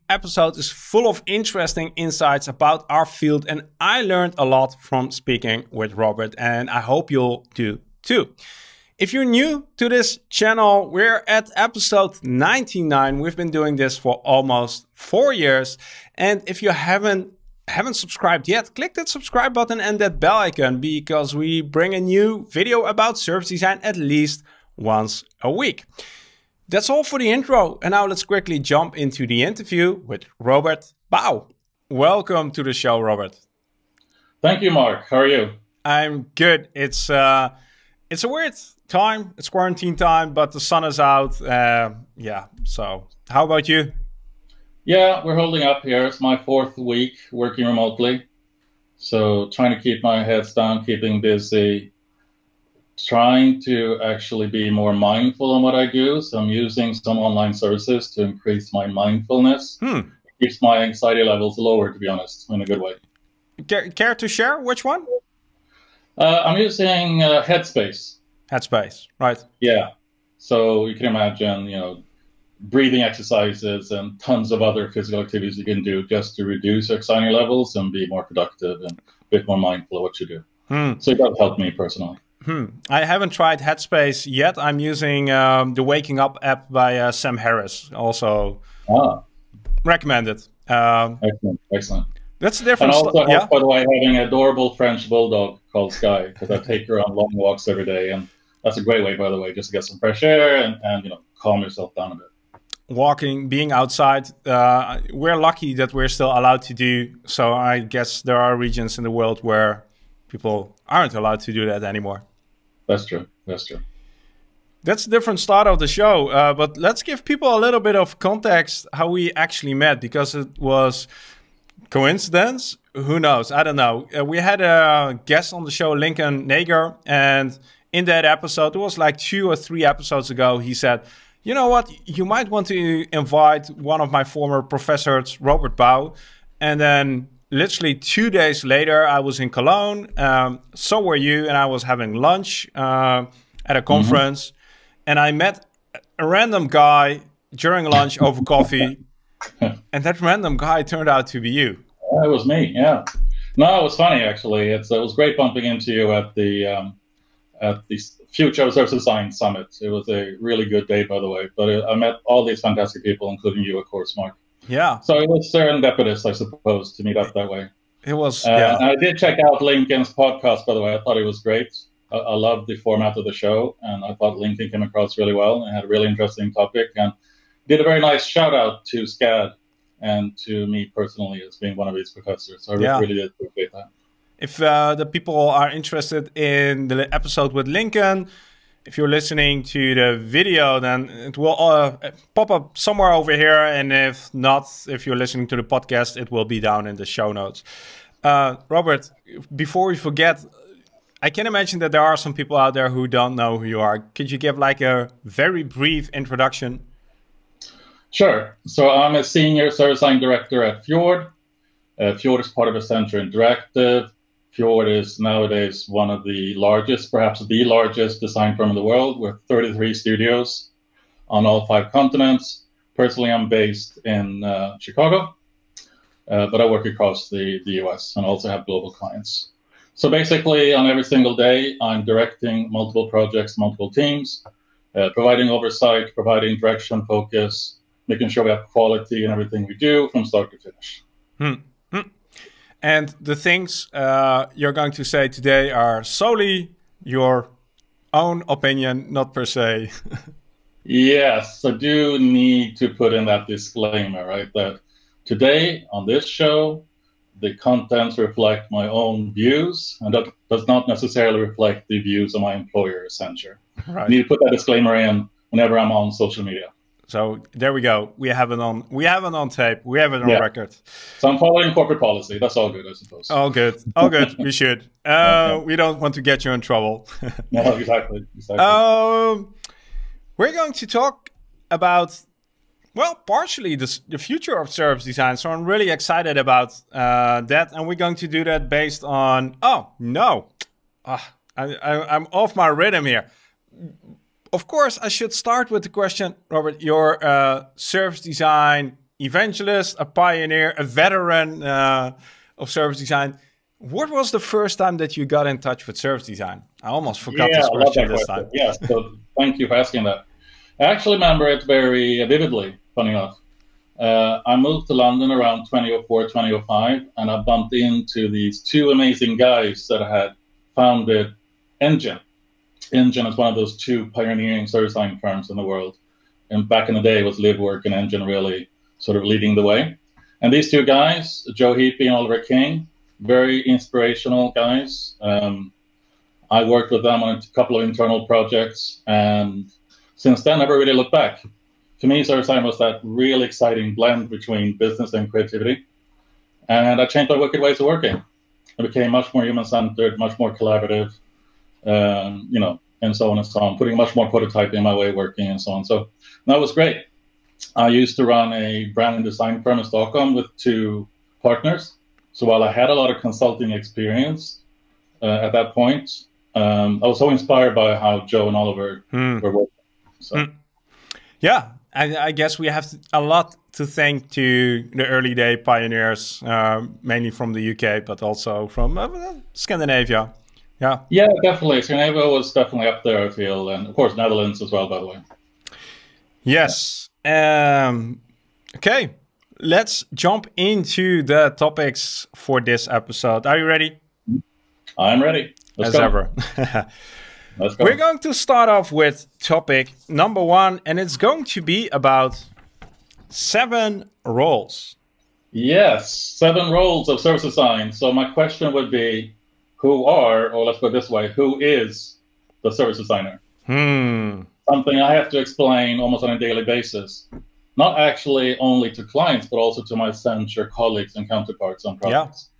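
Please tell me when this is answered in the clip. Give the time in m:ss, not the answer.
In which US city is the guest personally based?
3:44.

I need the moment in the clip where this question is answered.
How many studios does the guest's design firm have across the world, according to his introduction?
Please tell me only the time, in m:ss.
3:39.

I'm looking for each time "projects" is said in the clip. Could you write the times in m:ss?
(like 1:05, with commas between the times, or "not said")
3:53, 5:38, 7:01.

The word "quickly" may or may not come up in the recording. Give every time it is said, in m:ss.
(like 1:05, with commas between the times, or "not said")
0:28.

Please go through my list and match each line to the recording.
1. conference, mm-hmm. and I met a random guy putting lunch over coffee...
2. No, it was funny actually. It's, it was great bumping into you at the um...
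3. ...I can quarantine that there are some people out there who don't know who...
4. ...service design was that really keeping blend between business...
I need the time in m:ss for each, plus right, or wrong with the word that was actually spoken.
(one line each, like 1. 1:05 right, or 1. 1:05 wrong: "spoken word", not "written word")
1. 2:23 wrong: "during", not "putting"
2. 2:33 right
3. 3:21 wrong: "imagine", not "quarantine"
4. 5:42 wrong: "exciting", not "keeping".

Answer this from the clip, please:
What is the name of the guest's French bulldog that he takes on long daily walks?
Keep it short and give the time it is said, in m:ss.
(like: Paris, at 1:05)
Sky, at 1:35.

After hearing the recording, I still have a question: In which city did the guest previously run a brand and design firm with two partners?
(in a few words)
Stockholm.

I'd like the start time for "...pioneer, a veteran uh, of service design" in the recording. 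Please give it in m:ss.
5:00.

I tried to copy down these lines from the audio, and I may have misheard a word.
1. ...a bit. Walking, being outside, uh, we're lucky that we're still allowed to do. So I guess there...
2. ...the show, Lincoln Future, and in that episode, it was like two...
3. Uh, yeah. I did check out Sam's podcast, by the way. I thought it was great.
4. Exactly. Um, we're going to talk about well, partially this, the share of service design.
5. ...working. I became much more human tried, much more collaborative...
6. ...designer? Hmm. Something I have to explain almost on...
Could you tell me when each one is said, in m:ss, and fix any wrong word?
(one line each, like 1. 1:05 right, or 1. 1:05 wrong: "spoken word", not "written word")
1. 1:42 right
2. 2:05 wrong: "Nager", not "Future"
3. 2:48 wrong: "Lincoln", not "Sam"
4. 4:38 wrong: "future", not "share"
5. 5:47 wrong: "centered", not "tried"
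6. 6:52 right.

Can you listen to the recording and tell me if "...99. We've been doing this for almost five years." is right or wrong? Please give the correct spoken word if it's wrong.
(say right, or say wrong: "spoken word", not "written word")
wrong: "four", not "five".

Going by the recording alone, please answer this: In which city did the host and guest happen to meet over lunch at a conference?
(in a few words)
Cologne.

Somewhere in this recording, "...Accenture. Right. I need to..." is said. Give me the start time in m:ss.
4:23.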